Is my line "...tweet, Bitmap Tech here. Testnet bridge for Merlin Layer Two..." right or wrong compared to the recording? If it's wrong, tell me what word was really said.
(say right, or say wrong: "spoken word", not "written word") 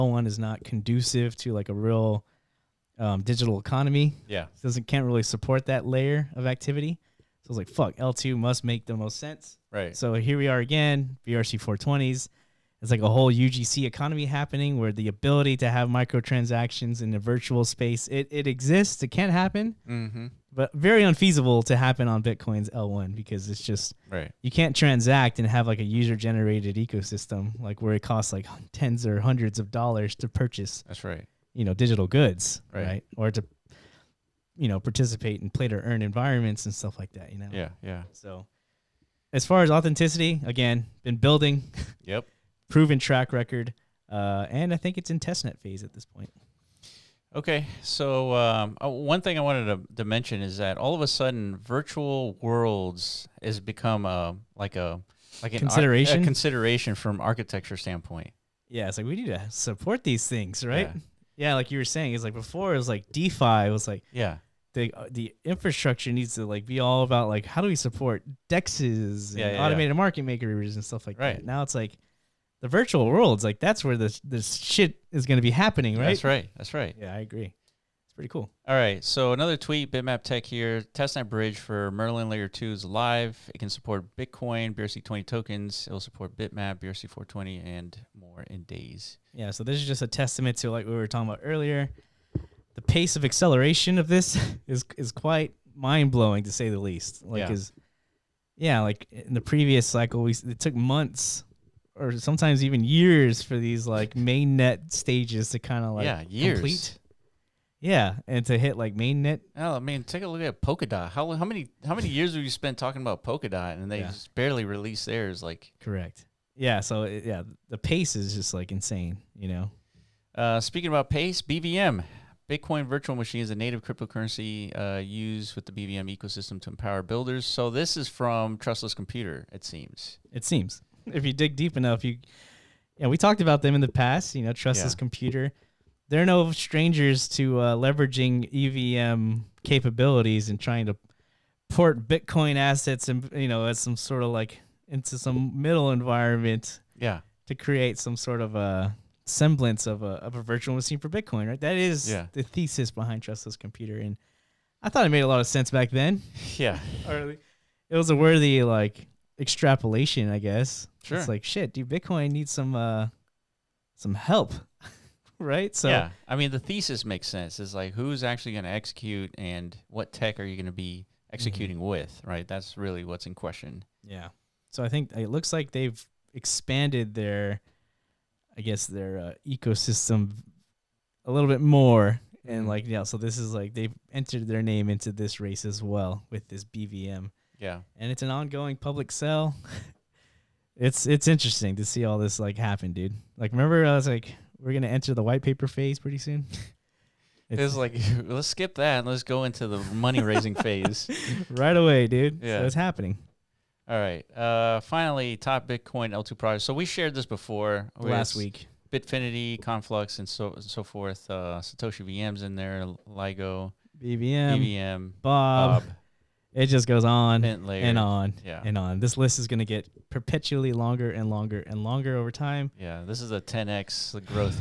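right.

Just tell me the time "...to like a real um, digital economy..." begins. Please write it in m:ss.
0:01.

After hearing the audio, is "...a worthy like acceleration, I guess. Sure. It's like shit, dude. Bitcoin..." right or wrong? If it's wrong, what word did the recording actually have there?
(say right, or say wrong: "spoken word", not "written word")
wrong: "extrapolation", not "acceleration".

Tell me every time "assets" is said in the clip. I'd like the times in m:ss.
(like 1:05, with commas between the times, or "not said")
2:22.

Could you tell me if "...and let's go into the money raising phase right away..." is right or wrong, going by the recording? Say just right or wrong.
right.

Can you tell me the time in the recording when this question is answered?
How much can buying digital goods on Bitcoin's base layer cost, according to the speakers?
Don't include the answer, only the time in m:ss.
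0:28.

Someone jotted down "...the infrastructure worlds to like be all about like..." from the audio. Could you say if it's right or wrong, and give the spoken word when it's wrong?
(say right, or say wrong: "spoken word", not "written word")
wrong: "needs", not "worlds".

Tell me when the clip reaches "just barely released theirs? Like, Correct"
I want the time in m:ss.
1:54.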